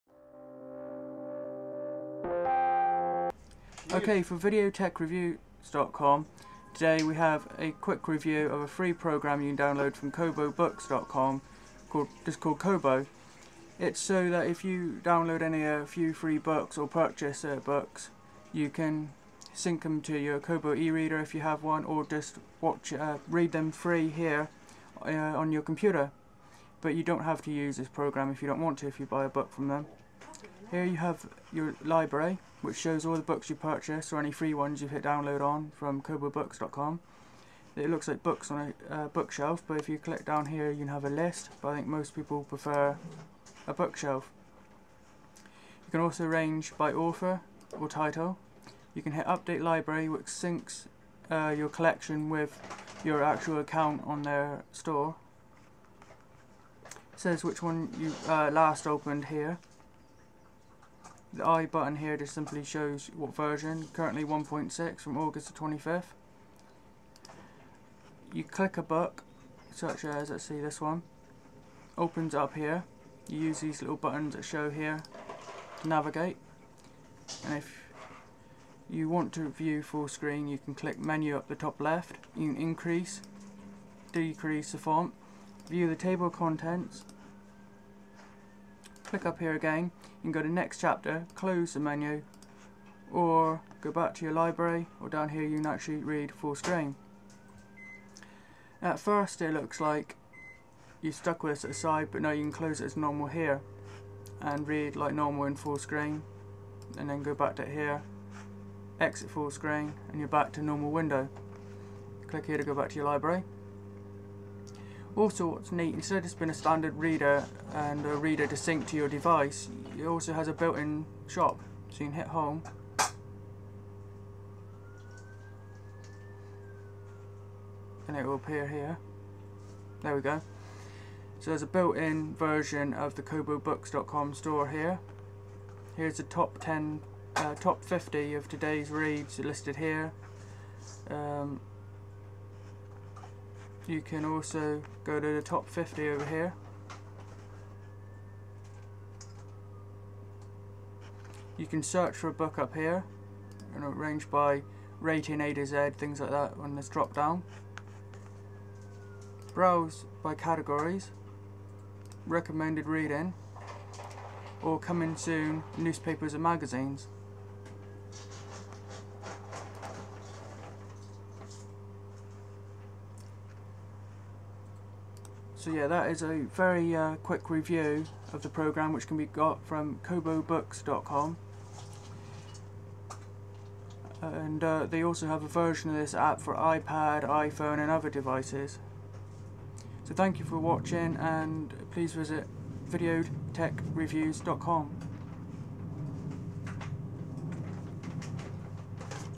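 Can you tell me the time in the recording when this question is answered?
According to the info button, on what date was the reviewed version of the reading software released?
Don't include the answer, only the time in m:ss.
1:05.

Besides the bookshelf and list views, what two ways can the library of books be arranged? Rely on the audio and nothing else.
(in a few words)
author or title.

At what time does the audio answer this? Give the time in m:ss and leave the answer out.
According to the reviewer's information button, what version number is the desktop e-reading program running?
1:04.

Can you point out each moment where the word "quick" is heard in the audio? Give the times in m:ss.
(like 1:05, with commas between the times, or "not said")
0:07, 2:57.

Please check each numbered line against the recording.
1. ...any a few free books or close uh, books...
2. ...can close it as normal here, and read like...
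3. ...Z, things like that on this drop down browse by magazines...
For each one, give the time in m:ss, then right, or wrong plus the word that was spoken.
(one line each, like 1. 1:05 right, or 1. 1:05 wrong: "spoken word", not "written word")
1. 0:15 wrong: "purchase", not "close"
2. 1:42 right
3. 2:35 wrong: "categories", not "magazines".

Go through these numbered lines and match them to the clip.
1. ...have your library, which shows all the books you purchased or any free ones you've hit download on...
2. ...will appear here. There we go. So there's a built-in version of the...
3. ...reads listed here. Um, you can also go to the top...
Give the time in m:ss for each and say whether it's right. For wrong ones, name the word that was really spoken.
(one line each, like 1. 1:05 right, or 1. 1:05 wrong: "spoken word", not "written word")
1. 0:30 right
2. 2:08 right
3. 2:18 right.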